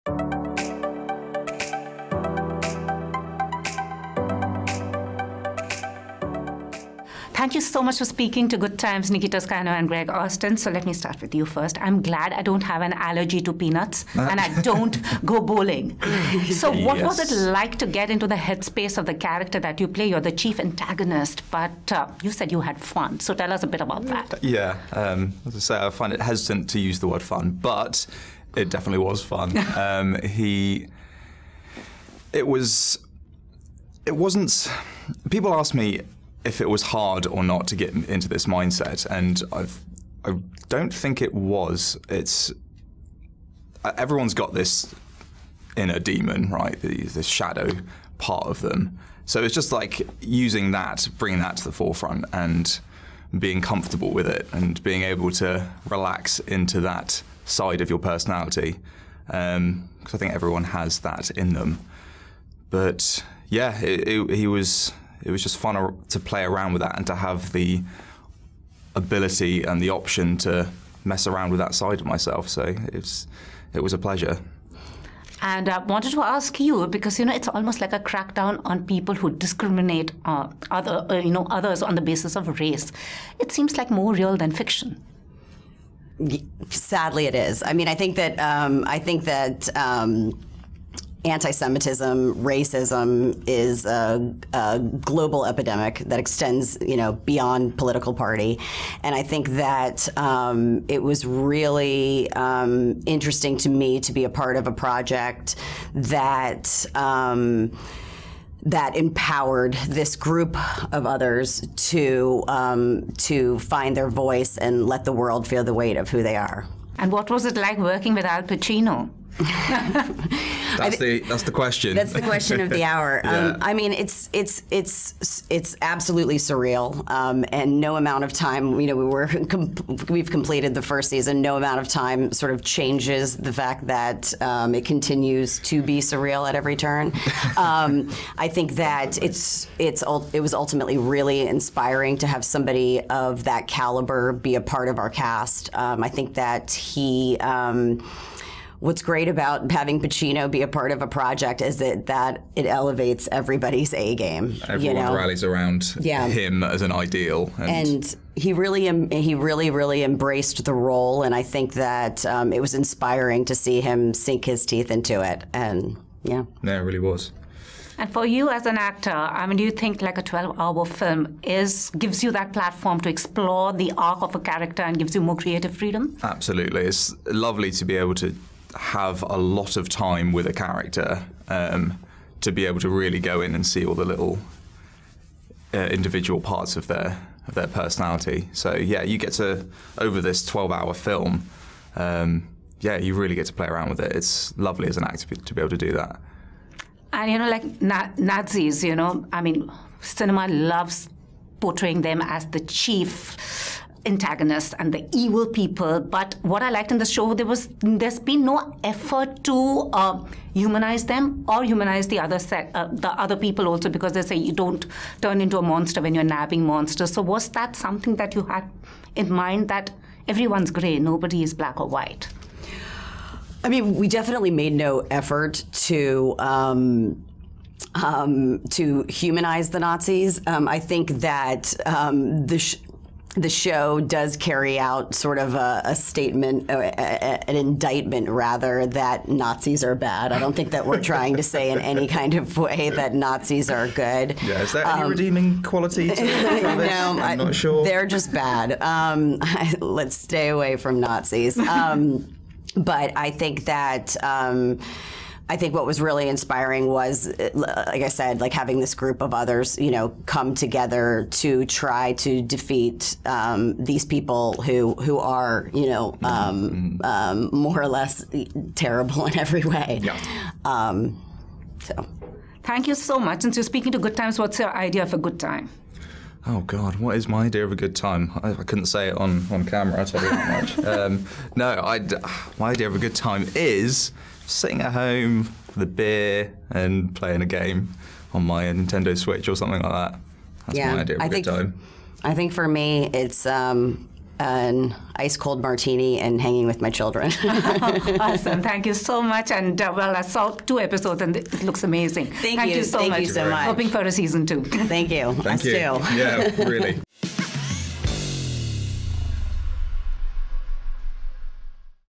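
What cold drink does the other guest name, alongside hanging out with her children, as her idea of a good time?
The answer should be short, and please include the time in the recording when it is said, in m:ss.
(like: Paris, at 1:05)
martini, at 4:55.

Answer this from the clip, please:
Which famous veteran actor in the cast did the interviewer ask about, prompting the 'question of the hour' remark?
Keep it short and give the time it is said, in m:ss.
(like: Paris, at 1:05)
Al Pacino, at 1:58.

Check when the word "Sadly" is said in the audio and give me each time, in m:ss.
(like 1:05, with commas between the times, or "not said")
1:26.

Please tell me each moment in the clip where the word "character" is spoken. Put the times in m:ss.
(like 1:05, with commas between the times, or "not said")
0:19, 2:54, 3:00.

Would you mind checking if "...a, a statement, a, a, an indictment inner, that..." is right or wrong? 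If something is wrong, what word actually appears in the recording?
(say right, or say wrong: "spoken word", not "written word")
wrong: "rather", not "inner".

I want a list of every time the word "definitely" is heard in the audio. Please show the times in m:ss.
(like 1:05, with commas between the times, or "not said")
0:28, 3:44.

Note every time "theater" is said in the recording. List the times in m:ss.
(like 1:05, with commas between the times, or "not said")
not said.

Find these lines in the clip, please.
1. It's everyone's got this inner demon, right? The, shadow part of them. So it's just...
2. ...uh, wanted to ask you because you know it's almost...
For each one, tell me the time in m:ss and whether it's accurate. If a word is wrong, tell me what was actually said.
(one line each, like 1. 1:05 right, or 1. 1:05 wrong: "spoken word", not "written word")
1. 0:42 right
2. 1:15 right.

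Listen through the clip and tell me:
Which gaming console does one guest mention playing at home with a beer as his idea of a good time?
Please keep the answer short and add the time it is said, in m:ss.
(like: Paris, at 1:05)
Nintendo Switch, at 4:48.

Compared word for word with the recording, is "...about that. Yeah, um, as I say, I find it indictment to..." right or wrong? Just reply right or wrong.
wrong.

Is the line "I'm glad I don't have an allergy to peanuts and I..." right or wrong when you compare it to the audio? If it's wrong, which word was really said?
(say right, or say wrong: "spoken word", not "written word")
right.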